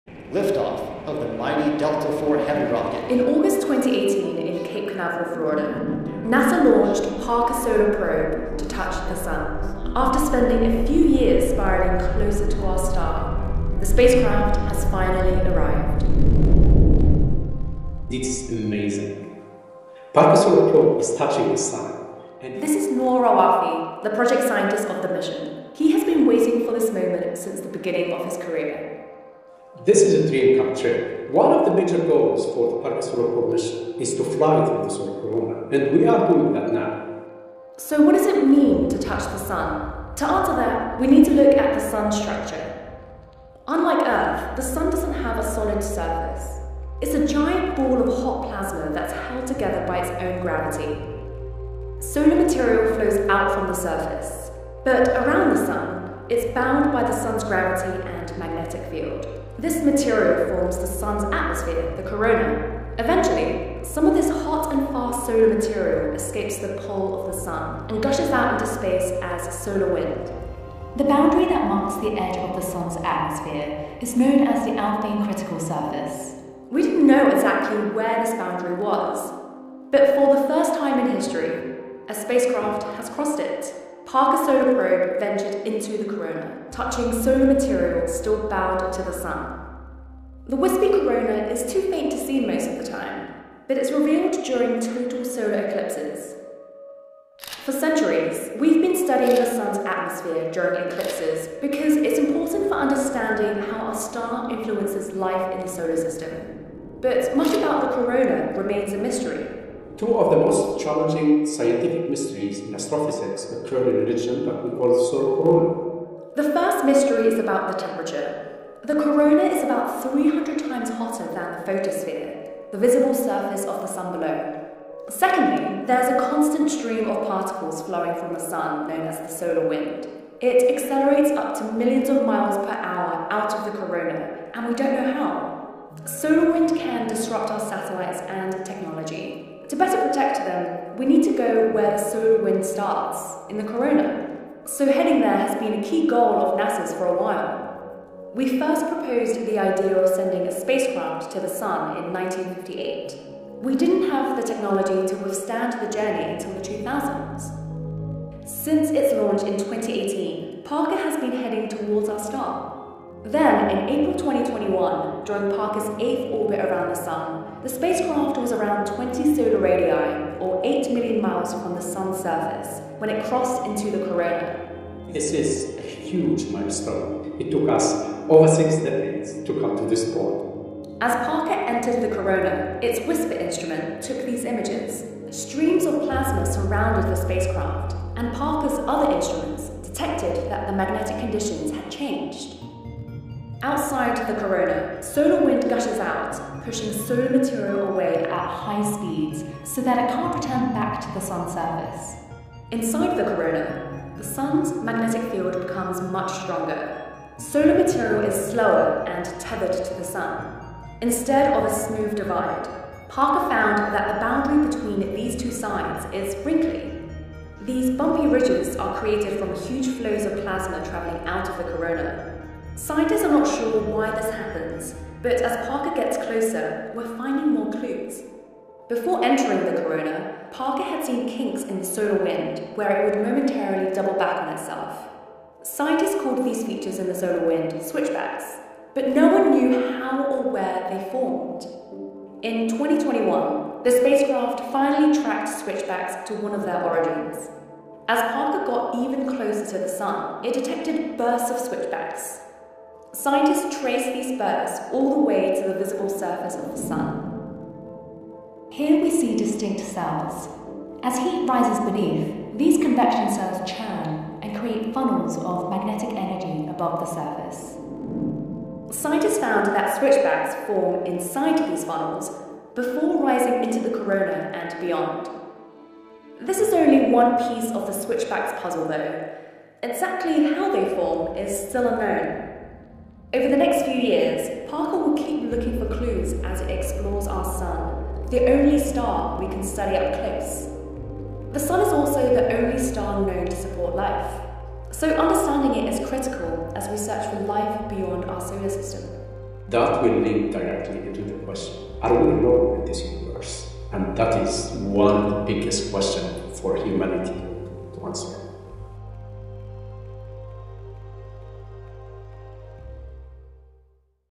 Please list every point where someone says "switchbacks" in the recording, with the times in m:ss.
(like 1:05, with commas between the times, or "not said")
3:57, 4:05, 4:11, 4:29, 4:37.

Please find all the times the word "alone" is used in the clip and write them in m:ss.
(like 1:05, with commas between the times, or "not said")
5:02.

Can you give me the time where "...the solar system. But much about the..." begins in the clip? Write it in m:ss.
1:45.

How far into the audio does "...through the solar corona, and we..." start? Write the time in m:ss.
0:34.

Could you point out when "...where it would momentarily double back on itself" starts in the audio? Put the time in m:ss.
3:52.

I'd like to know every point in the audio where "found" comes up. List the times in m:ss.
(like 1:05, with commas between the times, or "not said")
3:33, 4:29.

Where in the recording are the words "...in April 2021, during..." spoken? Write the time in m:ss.
2:43.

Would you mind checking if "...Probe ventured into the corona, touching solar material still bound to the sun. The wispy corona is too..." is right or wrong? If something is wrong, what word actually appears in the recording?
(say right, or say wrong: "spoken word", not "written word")
right.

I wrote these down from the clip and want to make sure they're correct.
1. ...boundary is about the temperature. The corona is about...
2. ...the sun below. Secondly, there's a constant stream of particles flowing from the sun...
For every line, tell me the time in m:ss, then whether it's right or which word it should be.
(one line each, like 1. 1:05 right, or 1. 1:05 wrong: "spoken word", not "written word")
1. 1:56 wrong: "mystery", not "boundary"
2. 2:03 right.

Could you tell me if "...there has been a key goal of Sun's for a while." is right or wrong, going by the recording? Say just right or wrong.
wrong.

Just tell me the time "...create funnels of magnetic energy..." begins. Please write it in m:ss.
4:24.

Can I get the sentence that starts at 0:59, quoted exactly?
This material forms the sun's atmosphere, the corona.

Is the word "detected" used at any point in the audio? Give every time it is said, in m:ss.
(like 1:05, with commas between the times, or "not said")
3:09, 4:10.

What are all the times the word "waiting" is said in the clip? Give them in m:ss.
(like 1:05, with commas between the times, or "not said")
0:26.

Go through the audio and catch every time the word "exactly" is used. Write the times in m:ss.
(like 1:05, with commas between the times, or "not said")
1:17, 4:39.